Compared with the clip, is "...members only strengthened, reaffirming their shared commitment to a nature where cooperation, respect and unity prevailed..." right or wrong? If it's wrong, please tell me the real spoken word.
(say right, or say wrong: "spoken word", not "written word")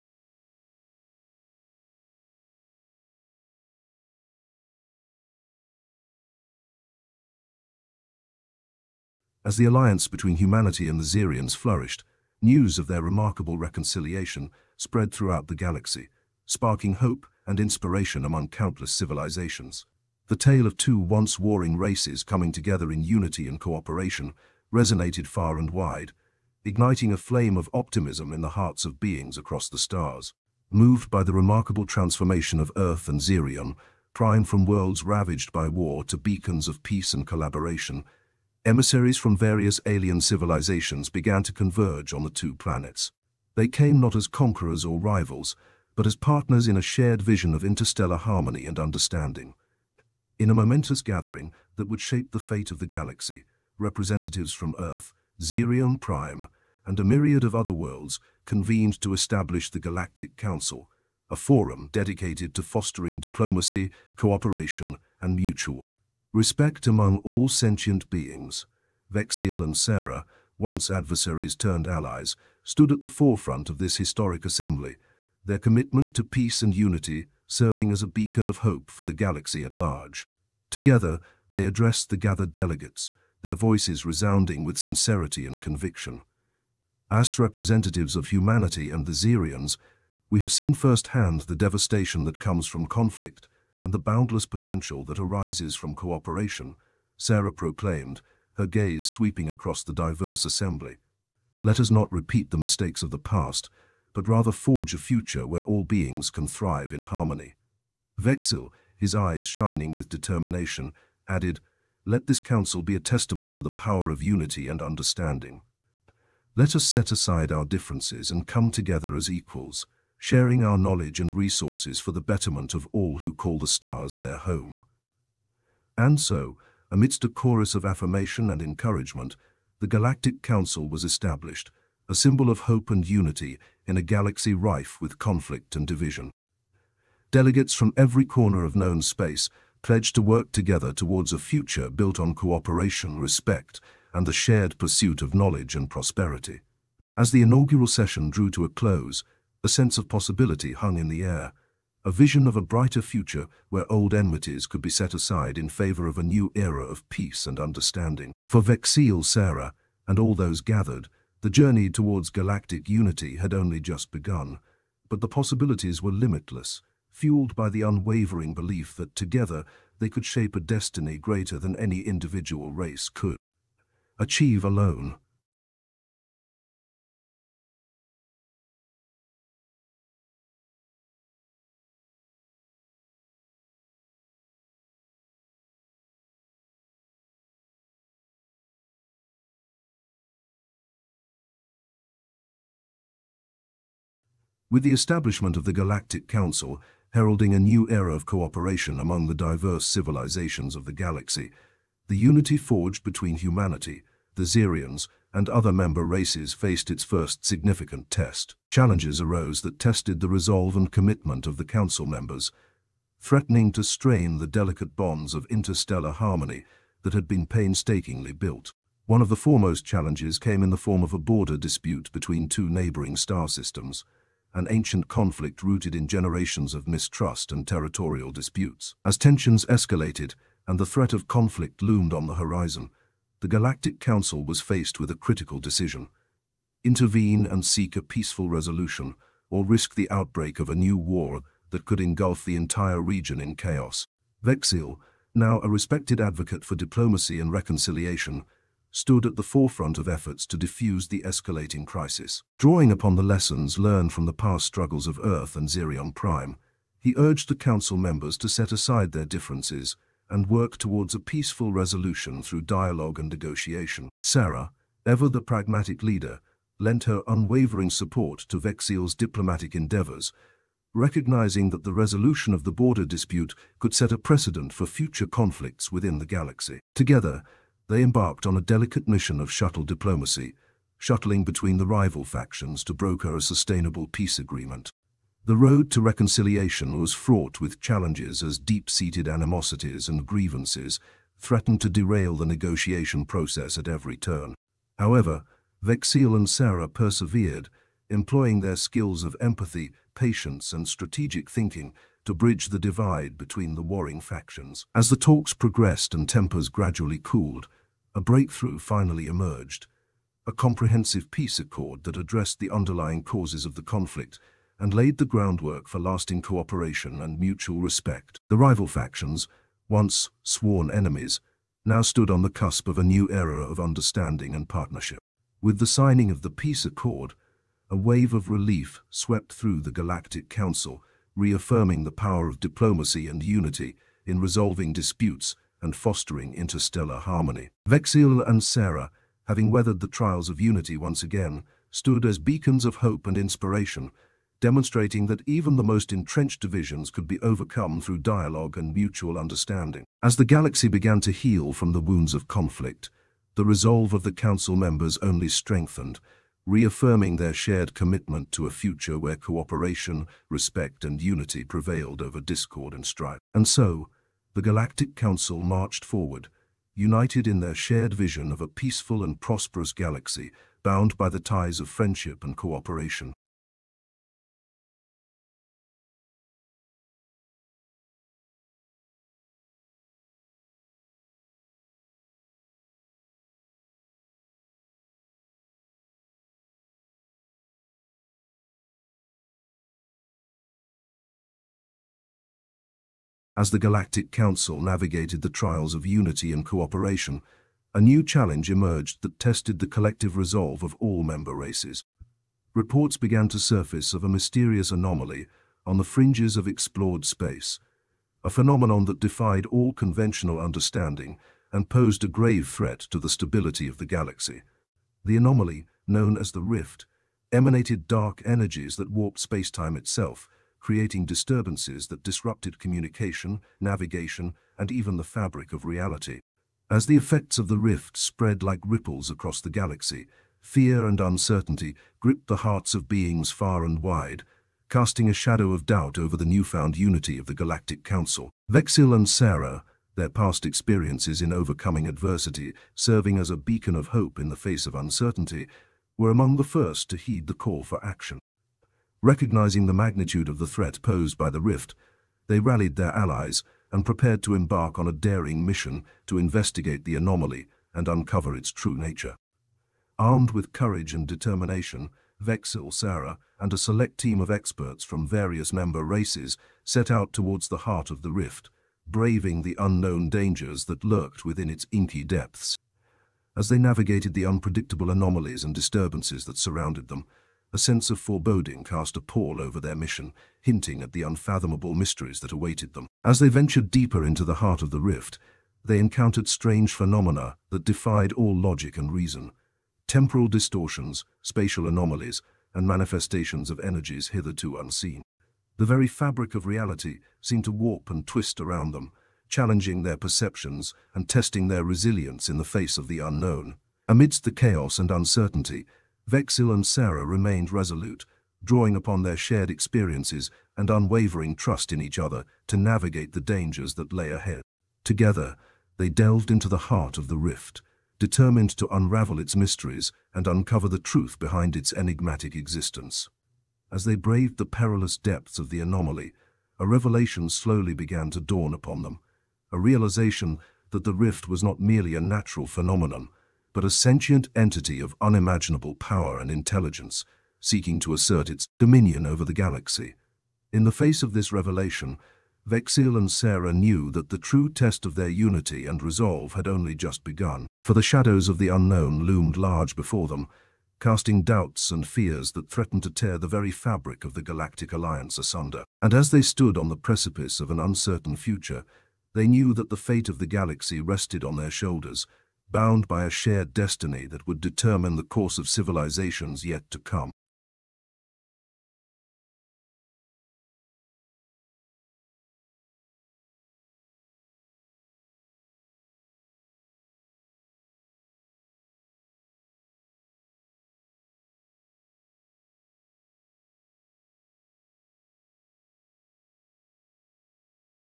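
wrong: "future", not "nature".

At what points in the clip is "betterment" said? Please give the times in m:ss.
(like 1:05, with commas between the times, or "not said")
2:02.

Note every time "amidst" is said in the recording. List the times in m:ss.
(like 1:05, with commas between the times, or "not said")
2:06, 8:24.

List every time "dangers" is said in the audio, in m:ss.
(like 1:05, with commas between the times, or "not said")
7:50, 8:33.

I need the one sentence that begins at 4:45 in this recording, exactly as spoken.
The road to reconciliation was fraught with challenges as deep-seated animosities and grievances threatened to derail the negotiation process at every turn.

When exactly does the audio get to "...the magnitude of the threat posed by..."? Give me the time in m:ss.
7:29.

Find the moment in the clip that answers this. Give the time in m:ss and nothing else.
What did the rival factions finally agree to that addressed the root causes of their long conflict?
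5:10.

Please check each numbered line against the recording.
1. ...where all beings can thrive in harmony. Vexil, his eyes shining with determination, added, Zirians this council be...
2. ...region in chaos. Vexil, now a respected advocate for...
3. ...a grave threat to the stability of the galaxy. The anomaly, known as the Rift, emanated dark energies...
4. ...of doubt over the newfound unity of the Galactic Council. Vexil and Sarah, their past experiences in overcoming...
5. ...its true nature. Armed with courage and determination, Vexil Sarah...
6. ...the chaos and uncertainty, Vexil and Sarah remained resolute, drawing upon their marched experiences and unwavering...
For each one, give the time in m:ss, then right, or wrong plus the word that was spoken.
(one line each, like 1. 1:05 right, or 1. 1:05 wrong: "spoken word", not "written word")
1. 1:45 wrong: "Let", not "Zirians"
2. 4:03 right
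3. 6:52 right
4. 7:15 right
5. 7:38 right
6. 8:24 wrong: "shared", not "marched".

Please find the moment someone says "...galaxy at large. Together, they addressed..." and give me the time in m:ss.
1:19.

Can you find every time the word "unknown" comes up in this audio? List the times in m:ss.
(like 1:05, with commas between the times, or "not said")
7:49, 8:23, 9:08.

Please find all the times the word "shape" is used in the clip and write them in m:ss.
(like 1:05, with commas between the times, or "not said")
0:52, 2:50.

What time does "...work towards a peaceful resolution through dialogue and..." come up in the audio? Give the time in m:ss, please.
4:20.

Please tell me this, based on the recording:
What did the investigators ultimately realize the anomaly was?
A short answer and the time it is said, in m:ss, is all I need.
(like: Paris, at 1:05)
sentient entity, at 8:53.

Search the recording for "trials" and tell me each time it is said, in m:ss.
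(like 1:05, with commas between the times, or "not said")
5:40, 6:35.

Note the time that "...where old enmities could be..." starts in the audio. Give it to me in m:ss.
2:33.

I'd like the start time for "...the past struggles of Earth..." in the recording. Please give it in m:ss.
4:14.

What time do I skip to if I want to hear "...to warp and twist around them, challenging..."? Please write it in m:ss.
8:17.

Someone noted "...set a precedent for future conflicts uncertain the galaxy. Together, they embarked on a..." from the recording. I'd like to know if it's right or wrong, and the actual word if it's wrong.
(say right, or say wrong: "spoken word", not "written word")
wrong: "within", not "uncertain".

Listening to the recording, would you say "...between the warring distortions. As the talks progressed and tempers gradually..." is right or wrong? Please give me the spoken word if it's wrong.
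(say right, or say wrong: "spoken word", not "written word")
wrong: "factions", not "distortions".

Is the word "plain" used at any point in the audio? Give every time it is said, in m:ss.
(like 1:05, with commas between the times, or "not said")
not said.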